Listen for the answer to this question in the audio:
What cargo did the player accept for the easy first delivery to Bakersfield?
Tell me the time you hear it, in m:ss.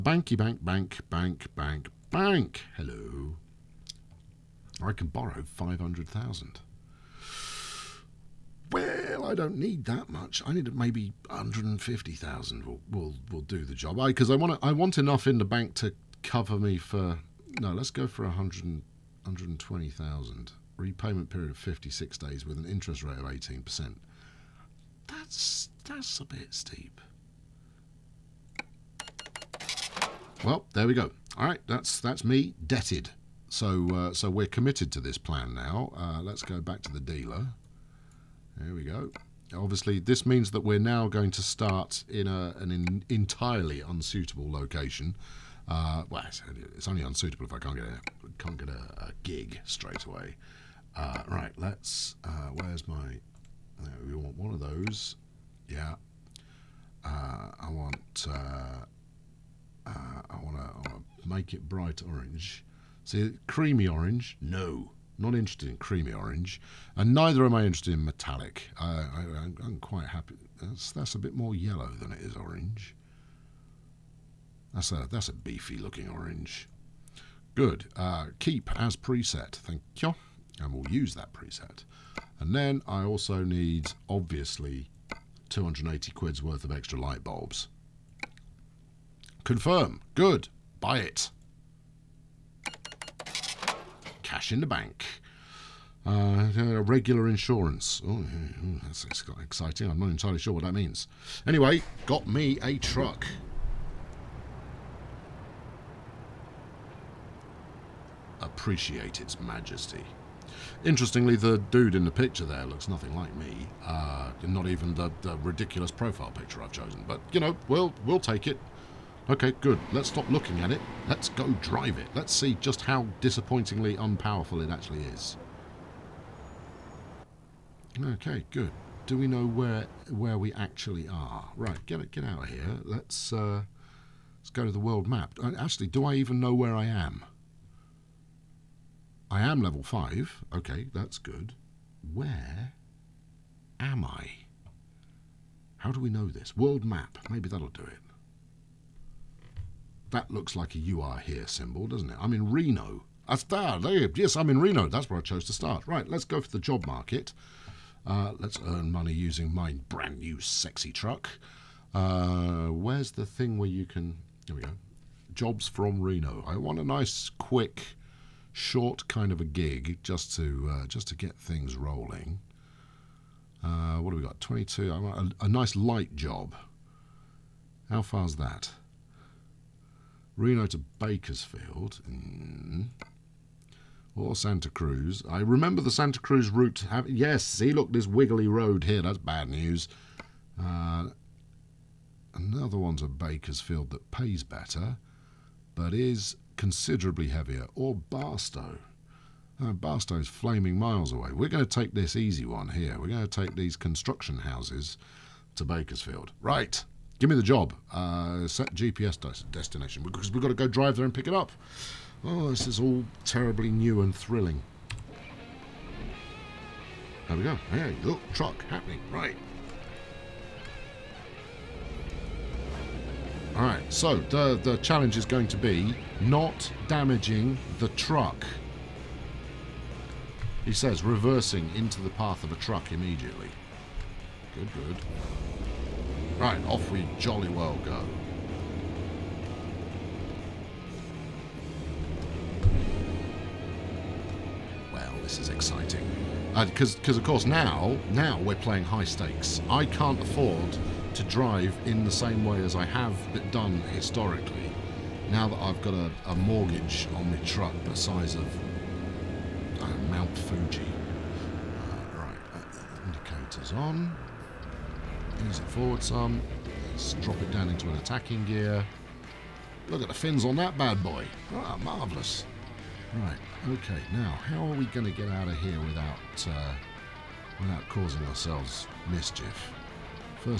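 3:23.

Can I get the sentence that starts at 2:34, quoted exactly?
That's where I chose to start.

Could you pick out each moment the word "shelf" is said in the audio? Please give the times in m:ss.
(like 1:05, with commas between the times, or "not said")
not said.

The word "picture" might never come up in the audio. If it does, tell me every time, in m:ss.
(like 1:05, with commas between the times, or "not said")
1:52, 1:56.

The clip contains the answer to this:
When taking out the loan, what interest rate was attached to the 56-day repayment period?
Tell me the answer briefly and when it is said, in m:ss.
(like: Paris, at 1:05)
18%, at 0:23.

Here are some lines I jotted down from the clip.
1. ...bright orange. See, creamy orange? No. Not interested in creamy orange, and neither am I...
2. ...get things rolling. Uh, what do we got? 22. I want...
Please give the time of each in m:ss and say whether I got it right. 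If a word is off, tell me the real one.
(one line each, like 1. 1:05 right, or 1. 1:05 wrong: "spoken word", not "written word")
1. 1:01 right
2. 2:51 right.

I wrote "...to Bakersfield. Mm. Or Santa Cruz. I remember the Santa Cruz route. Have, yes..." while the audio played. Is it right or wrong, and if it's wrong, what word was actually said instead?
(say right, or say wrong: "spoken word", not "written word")
right.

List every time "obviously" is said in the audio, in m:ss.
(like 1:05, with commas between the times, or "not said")
0:39, 1:24.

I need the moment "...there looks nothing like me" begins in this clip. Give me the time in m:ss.
1:52.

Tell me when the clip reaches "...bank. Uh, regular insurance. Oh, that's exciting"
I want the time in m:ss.
1:34.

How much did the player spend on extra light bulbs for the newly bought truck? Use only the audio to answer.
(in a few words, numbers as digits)
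280 quid.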